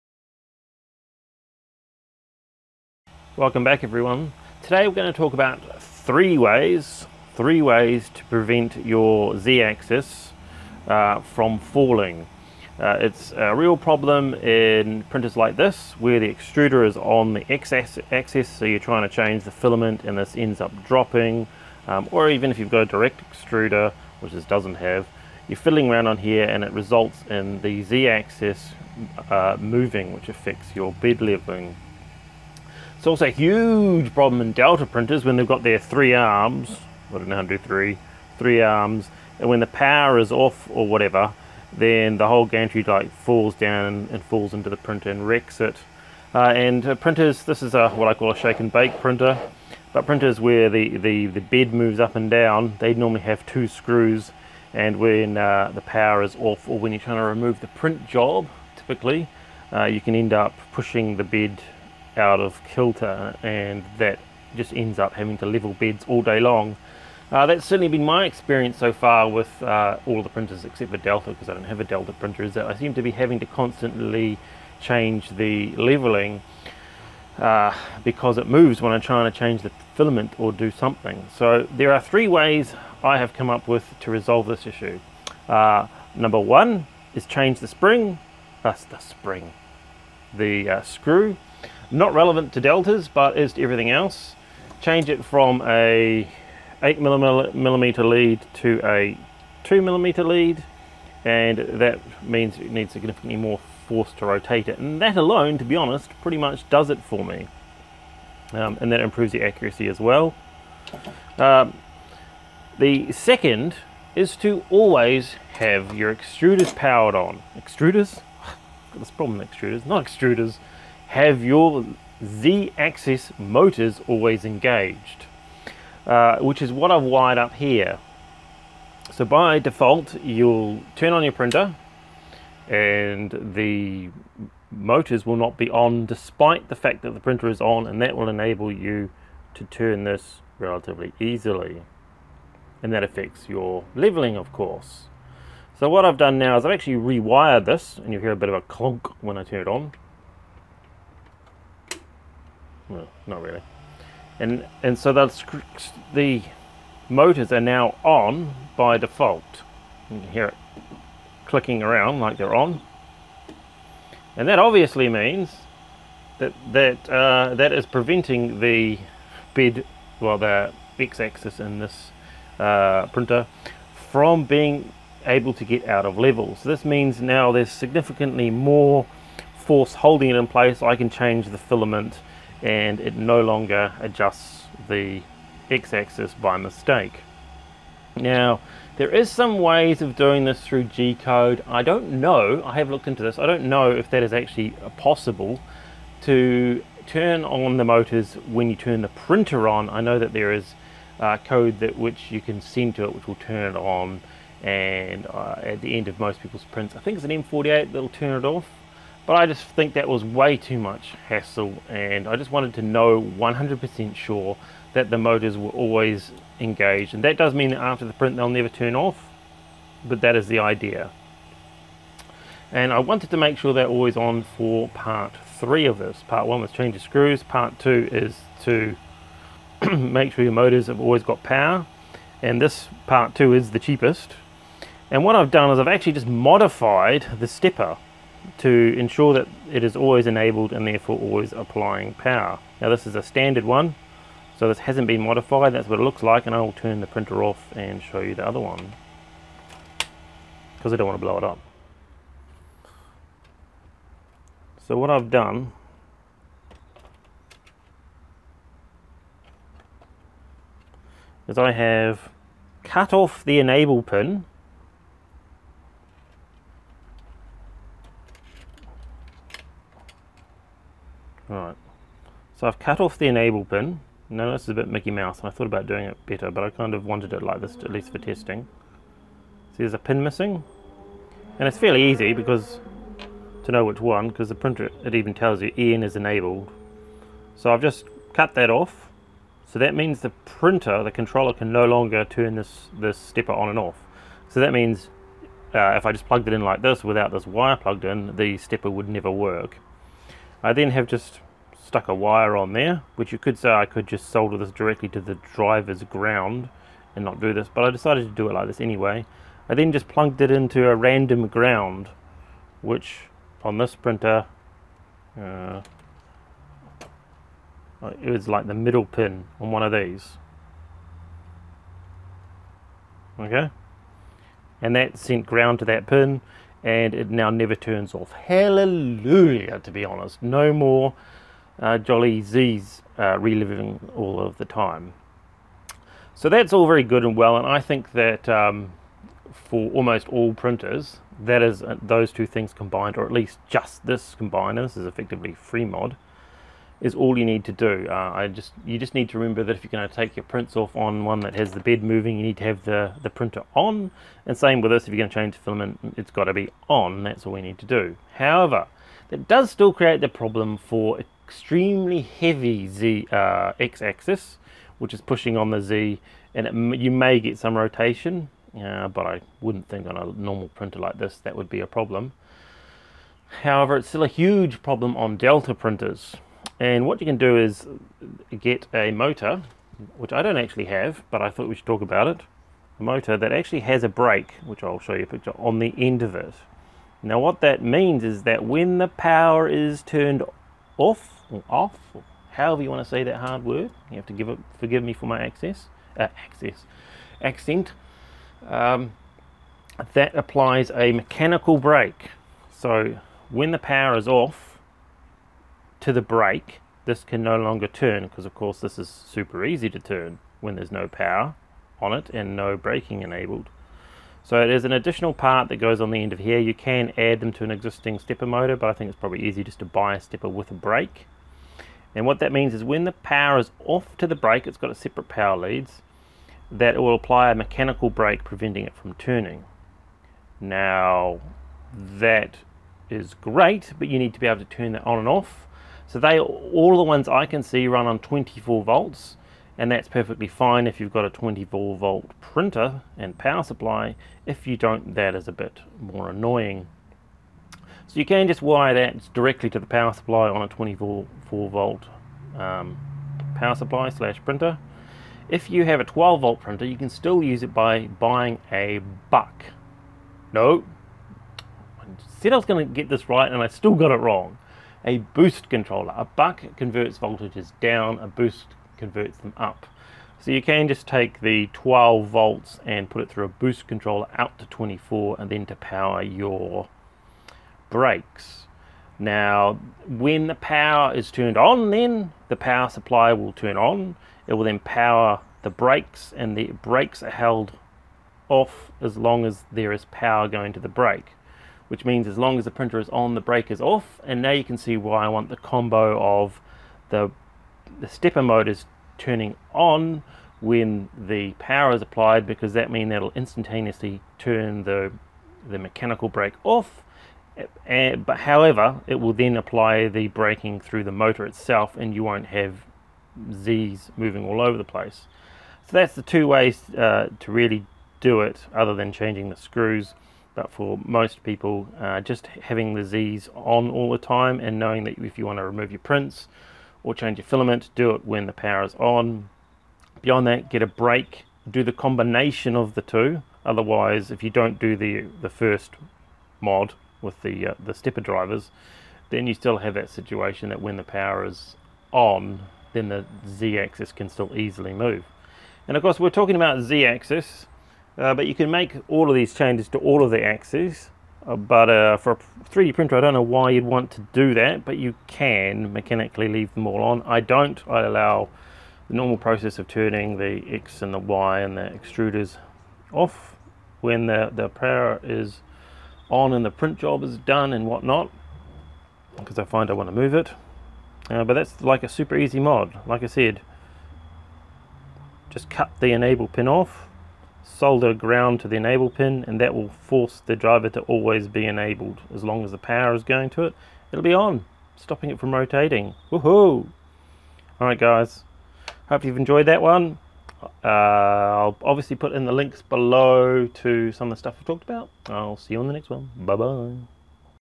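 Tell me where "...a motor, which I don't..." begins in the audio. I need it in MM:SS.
06:18.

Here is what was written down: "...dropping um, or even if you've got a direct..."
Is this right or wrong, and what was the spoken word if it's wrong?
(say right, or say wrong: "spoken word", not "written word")
right.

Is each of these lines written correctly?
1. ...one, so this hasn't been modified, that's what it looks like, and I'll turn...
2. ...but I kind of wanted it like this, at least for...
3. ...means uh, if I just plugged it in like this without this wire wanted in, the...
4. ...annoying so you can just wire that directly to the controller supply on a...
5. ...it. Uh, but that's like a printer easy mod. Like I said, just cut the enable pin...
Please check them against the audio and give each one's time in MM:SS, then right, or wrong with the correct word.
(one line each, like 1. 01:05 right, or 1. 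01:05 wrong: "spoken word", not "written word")
1. 04:03 right
2. 04:36 right
3. 04:54 wrong: "plugged", not "wanted"
4. 07:26 wrong: "power", not "controller"
5. 09:30 wrong: "super", not "printer".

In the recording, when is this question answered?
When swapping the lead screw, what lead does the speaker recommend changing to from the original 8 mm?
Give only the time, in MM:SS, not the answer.
01:39.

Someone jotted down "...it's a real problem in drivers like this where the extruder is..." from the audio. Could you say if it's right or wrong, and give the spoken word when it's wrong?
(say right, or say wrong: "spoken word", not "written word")
wrong: "printers", not "drivers".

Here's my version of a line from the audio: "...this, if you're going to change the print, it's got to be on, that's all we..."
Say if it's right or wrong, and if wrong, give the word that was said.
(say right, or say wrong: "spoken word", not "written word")
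wrong: "filament", not "print".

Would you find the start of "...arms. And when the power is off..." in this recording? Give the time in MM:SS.
00:38.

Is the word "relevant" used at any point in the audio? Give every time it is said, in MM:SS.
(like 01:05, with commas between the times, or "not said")
01:32.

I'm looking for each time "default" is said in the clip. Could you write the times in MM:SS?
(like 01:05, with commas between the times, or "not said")
02:09, 02:38.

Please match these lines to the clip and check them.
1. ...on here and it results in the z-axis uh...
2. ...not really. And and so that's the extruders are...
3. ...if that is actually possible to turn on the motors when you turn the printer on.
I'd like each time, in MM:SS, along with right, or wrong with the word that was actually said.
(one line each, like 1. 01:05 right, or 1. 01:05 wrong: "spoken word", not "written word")
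1. 00:26 right
2. 02:33 wrong: "motors", not "extruders"
3. 03:13 right.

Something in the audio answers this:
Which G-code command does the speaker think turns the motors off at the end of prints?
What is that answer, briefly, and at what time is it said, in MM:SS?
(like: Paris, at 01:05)
M48, at 03:27.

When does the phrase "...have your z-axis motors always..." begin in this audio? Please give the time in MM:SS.
02:01.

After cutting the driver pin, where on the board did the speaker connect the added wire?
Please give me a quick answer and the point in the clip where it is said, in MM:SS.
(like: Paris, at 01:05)
a random ground, at 05:10.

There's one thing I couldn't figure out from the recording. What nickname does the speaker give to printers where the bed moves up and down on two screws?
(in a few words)
shake and bake printer.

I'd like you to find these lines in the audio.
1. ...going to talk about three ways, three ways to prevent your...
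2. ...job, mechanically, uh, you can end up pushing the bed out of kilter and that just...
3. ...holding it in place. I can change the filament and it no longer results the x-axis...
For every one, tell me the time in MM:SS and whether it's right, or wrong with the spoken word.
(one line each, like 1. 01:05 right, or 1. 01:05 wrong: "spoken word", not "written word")
1. 00:04 right
2. 00:58 wrong: "typically", not "mechanically"
3. 02:59 wrong: "adjusts", not "results".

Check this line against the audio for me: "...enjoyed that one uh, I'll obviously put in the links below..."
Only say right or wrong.
right.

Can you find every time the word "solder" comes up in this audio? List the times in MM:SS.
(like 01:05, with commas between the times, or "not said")
05:04, 09:37.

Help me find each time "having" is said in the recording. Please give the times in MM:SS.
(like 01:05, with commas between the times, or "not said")
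01:05, 01:13, 08:42.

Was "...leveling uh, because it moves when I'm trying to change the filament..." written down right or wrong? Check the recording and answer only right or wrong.
right.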